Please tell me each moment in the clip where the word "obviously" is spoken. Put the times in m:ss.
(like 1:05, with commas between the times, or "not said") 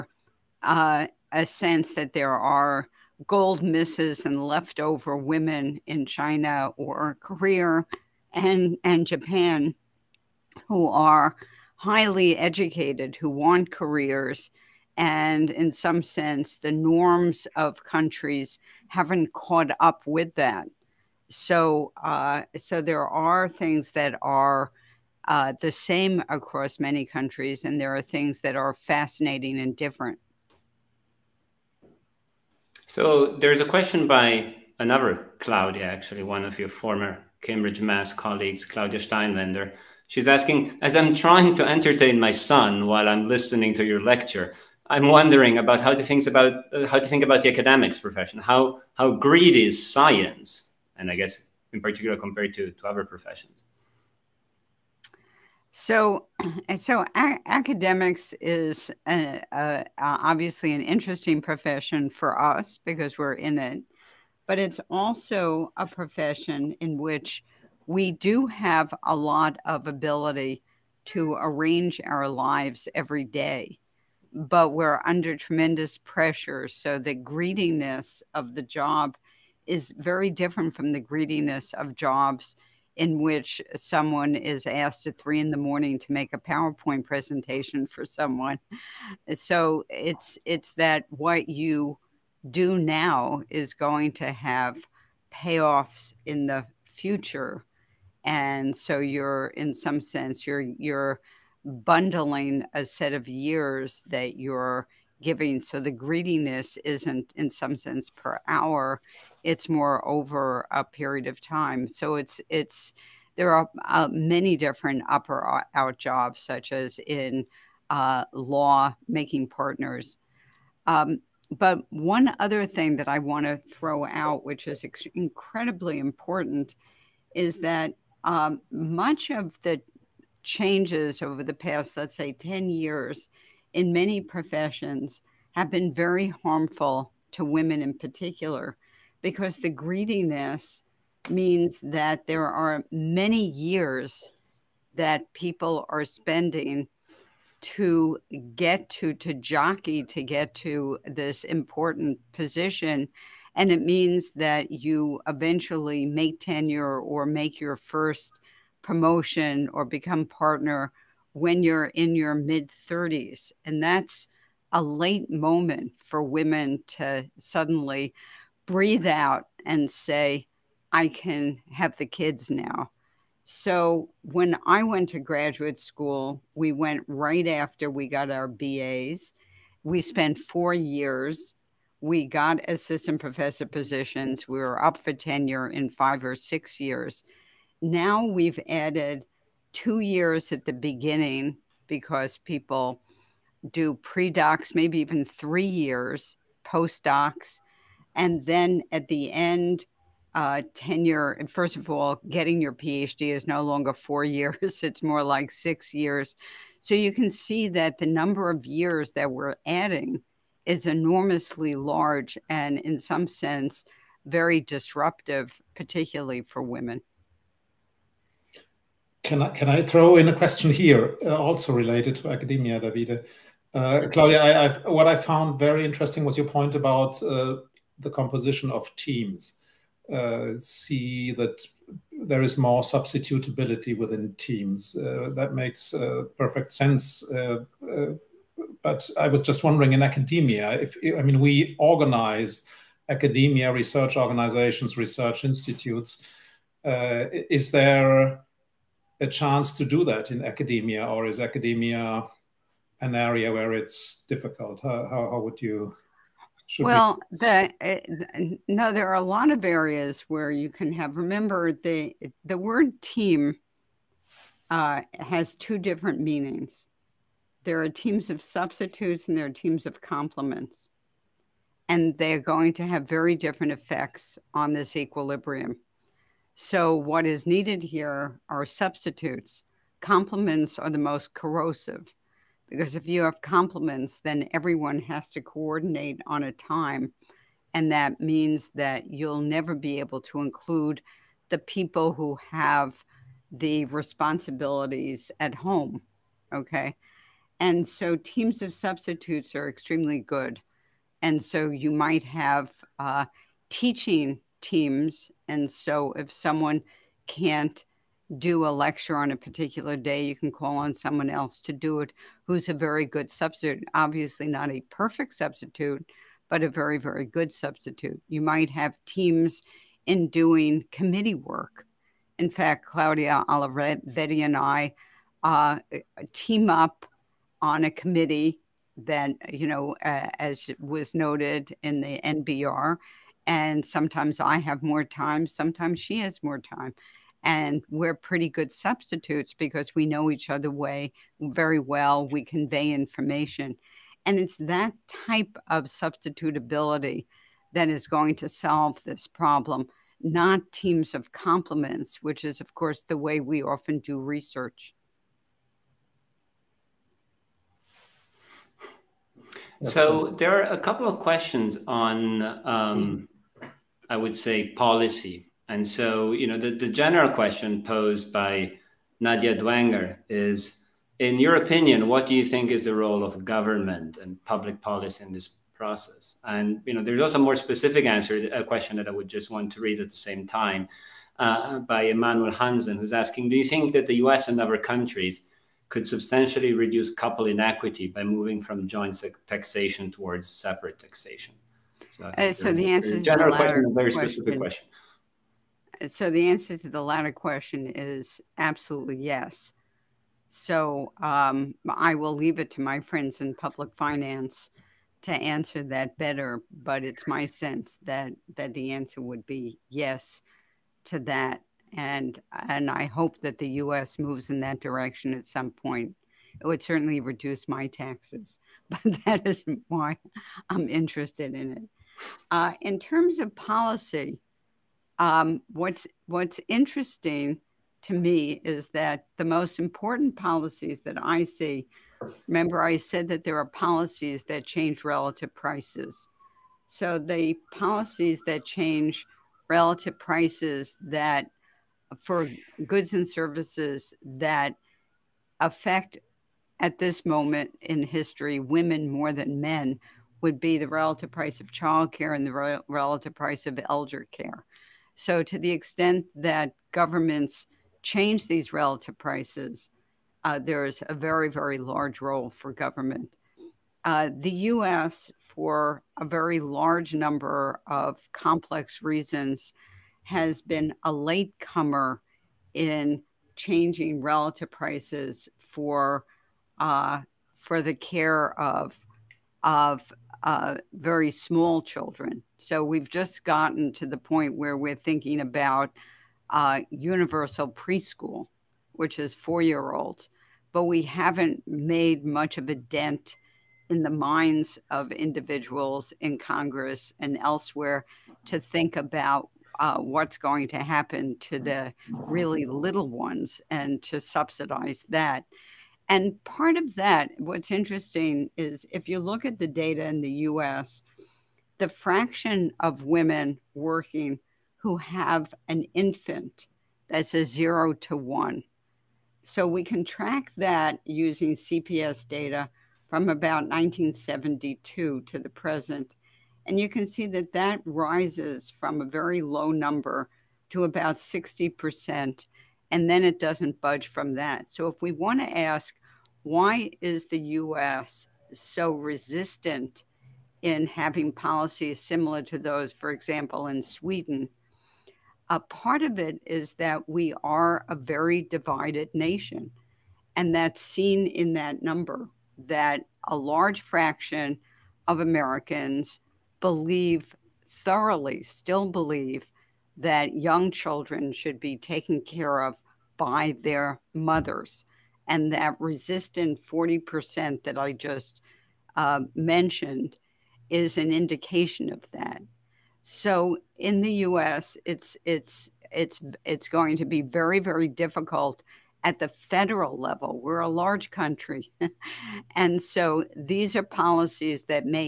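0:59, 5:13.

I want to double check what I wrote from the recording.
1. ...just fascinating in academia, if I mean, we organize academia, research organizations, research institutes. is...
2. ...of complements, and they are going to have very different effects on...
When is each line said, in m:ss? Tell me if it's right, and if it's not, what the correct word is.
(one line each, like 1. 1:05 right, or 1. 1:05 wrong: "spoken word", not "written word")
1. 3:59 wrong: "wondering", not "fascinating"
2. 4:29 right.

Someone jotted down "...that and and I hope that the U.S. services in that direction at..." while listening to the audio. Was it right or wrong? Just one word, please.
wrong.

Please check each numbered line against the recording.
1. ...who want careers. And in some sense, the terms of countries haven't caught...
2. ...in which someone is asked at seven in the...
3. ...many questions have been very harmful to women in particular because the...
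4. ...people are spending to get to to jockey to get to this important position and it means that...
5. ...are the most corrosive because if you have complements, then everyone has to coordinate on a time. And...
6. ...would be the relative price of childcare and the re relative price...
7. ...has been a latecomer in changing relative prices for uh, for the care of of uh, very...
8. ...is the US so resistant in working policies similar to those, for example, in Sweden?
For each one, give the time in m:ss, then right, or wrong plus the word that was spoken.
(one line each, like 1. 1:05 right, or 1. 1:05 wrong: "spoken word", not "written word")
1. 0:13 wrong: "norms", not "terms"
2. 1:22 wrong: "three", not "seven"
3. 2:13 wrong: "professions", not "questions"
4. 2:25 right
5. 4:40 right
6. 7:30 right
7. 7:50 right
8. 8:57 wrong: "having", not "working".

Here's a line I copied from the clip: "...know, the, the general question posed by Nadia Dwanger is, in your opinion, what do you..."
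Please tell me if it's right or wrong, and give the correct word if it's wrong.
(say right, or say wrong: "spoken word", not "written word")
right.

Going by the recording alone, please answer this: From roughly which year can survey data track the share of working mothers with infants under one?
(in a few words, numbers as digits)
1972.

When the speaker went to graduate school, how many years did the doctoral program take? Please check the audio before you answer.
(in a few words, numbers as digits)
4.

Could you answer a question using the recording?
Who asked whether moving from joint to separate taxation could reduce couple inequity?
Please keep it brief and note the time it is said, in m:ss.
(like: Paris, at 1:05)
Emmanuel Hansen, at 6:22.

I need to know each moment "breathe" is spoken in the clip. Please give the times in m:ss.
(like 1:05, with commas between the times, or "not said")
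2:48.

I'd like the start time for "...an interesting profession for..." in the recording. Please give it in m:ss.
1:00.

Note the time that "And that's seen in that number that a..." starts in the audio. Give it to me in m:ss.
9:10.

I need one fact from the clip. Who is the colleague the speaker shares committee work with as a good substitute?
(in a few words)
Claudia Olivetti.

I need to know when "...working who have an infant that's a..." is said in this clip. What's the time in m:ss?
8:33.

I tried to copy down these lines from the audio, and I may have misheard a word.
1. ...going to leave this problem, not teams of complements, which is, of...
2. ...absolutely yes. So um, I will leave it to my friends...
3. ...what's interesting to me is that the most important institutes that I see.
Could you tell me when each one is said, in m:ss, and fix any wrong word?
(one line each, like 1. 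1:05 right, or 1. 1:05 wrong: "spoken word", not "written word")
1. 5:48 wrong: "solve", not "leave"
2. 6:38 right
3. 7:06 wrong: "policies", not "institutes".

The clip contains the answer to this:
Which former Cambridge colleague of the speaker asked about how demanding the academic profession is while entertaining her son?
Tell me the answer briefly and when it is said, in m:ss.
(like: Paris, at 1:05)
Claudia Steinwender, at 0:38.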